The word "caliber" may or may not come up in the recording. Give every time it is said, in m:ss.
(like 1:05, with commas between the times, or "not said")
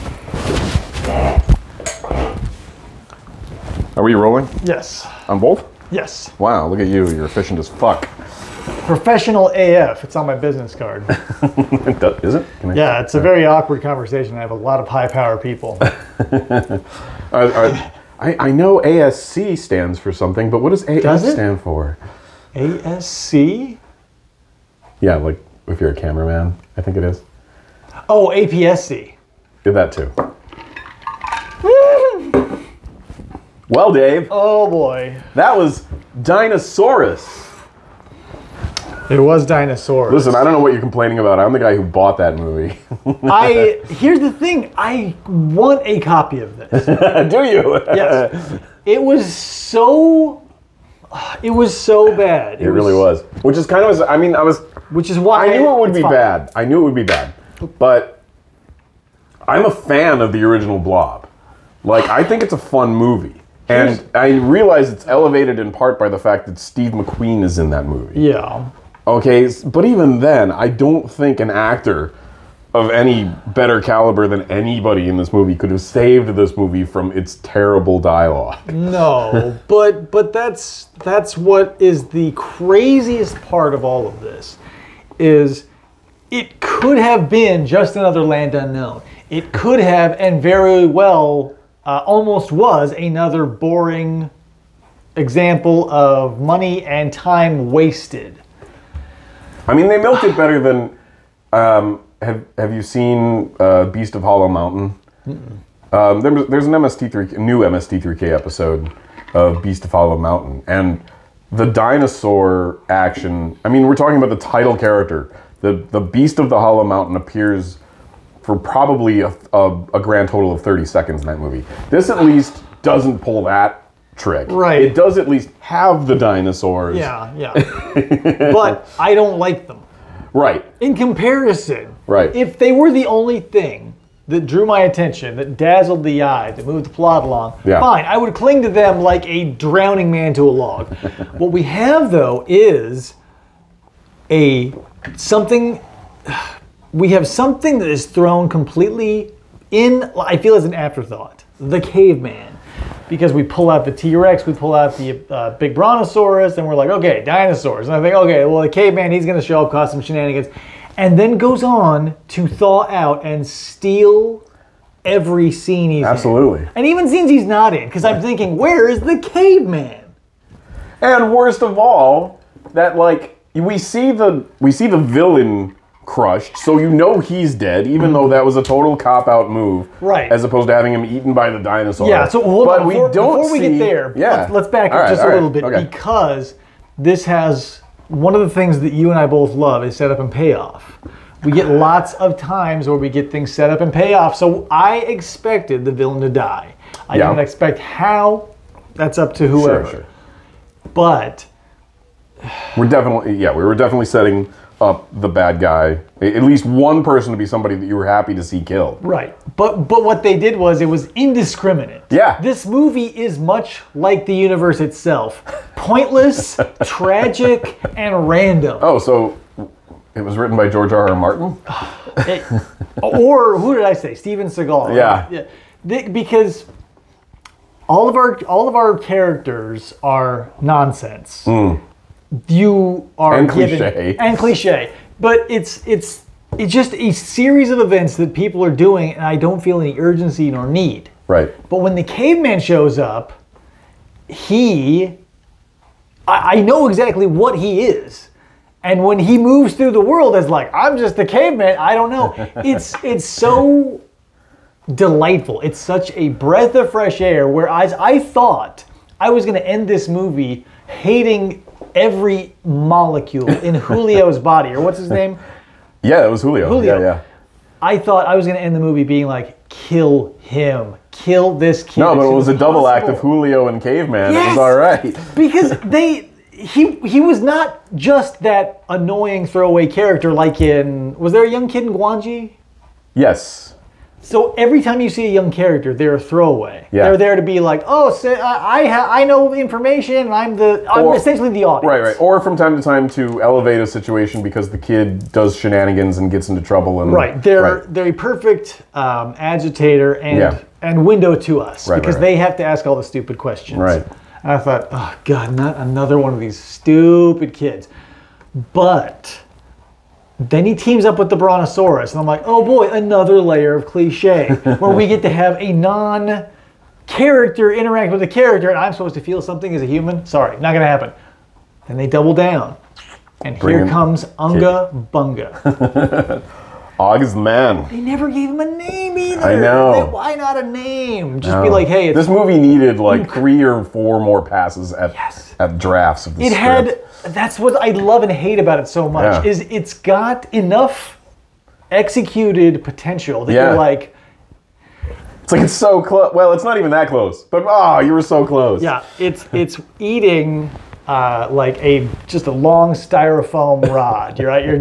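1:13.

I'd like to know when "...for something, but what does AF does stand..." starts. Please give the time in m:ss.
0:19.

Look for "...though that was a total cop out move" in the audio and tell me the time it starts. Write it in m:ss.
2:58.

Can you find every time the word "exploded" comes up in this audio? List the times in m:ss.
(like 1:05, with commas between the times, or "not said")
not said.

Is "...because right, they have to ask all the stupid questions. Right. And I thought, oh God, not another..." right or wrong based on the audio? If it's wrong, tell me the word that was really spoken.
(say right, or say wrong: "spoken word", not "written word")
right.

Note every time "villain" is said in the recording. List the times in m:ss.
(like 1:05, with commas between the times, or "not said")
2:54, 3:15.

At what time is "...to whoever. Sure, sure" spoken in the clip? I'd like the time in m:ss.
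3:19.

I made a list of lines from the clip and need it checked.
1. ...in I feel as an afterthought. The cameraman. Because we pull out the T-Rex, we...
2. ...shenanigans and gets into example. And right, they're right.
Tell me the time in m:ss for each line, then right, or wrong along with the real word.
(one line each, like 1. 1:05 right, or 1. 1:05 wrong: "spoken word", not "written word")
1. 2:29 wrong: "caveman", not "cameraman"
2. 4:55 wrong: "trouble", not "example".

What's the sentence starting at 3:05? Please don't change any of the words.
because this has one of the things that you and I both love is setup and payoff.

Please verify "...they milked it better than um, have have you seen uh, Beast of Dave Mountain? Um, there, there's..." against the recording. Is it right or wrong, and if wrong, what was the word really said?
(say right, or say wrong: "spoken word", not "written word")
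wrong: "Hollow", not "Dave".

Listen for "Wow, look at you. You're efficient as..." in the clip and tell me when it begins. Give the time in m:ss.
0:06.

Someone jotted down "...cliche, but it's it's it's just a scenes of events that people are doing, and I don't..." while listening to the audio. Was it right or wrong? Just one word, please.
wrong.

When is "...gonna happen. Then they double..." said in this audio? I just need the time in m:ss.
5:20.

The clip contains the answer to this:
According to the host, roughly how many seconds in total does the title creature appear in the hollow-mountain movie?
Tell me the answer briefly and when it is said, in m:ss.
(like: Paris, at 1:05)
30 seconds, at 2:00.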